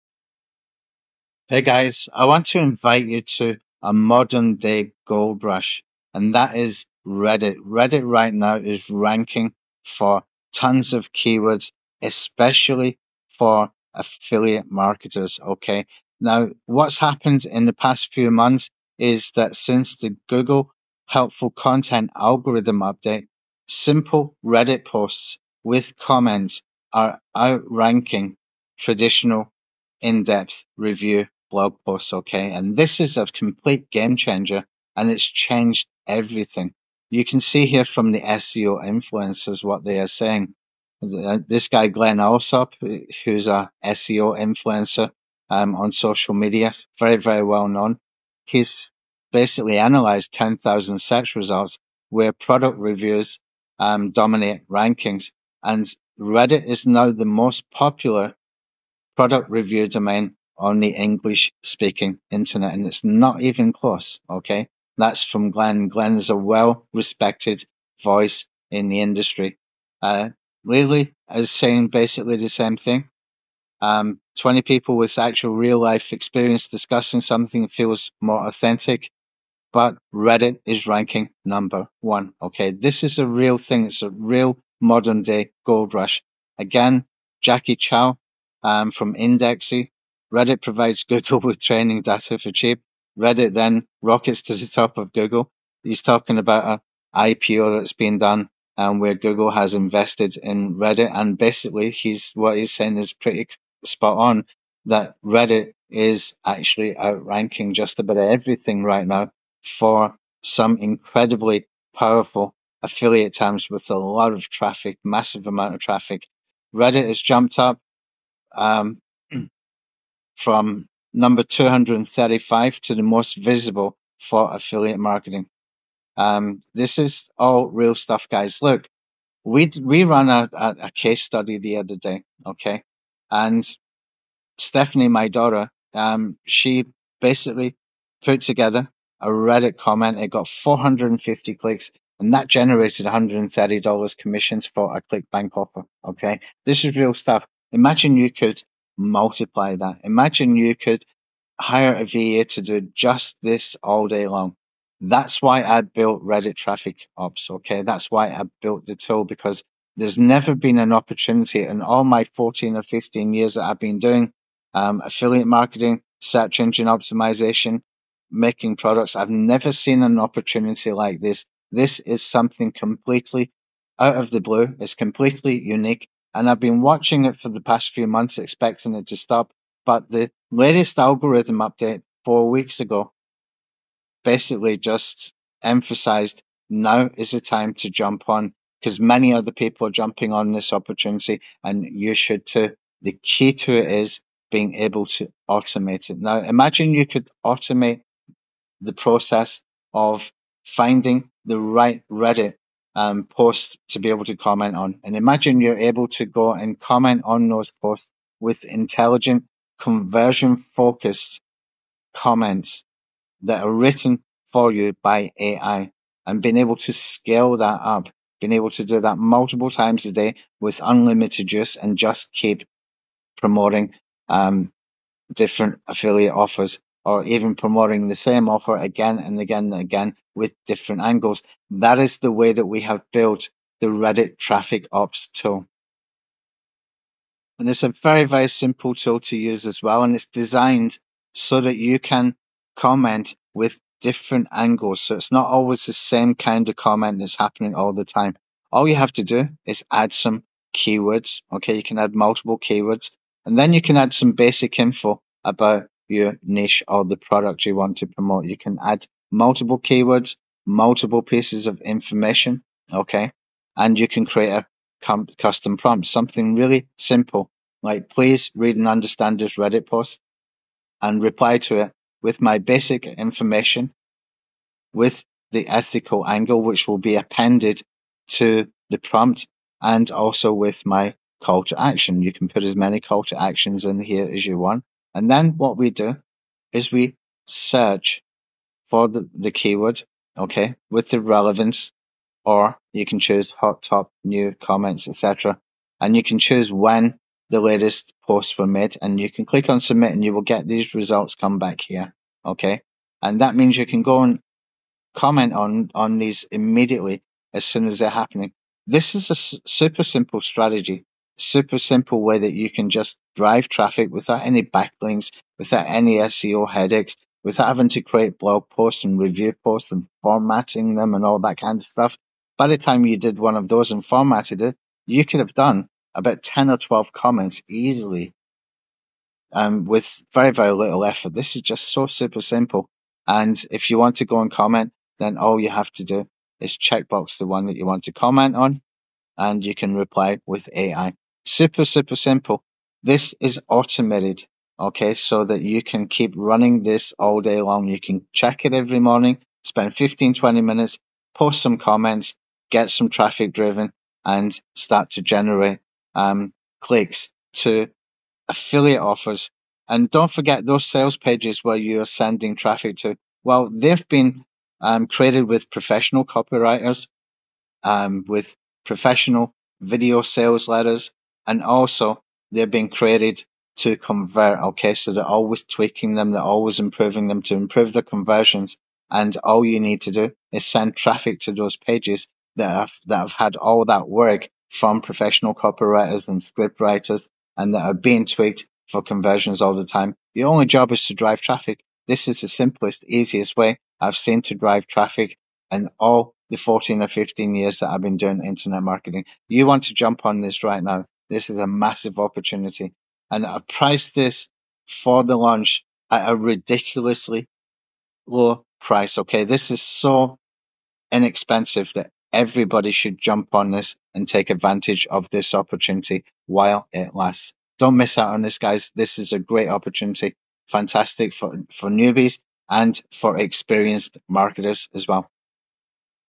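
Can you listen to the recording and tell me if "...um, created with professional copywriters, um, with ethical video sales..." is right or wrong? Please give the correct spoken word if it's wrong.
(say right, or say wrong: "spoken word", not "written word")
wrong: "professional", not "ethical".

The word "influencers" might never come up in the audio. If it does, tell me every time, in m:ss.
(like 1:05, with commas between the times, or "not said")
0:38, 0:44.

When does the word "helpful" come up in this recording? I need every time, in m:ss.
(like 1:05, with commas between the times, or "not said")
0:21.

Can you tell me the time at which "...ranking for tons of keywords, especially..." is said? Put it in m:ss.
0:08.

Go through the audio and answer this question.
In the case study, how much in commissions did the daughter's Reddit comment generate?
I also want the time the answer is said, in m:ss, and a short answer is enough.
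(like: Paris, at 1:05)
$130, at 2:23.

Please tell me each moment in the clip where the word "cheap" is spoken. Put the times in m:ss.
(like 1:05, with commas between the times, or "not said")
1:32.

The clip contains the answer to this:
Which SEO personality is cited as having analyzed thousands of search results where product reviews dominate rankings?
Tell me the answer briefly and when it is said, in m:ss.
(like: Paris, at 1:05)
Glen Allsopp, at 0:41.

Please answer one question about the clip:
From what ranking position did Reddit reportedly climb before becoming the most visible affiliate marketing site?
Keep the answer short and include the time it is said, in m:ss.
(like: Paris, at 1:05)
235, at 2:01.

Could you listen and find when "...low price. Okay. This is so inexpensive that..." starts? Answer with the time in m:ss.
6:48.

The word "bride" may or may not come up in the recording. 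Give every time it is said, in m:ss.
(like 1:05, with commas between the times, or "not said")
not said.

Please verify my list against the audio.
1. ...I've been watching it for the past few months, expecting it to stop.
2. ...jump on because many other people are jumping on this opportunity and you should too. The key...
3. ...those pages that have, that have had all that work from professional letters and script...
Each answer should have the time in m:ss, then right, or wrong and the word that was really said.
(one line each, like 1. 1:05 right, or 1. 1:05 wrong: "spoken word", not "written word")
1. 2:56 right
2. 3:07 right
3. 6:21 wrong: "copywriters", not "letters".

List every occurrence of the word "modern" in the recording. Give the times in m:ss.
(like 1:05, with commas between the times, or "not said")
0:03, 1:24.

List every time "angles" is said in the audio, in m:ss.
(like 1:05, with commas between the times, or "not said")
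3:51, 4:04, 4:36.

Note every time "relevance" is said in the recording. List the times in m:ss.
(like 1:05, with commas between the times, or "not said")
4:51.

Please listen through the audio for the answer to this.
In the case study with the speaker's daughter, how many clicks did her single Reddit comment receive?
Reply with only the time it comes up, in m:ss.
2:20.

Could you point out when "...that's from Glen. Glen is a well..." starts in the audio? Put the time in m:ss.
1:04.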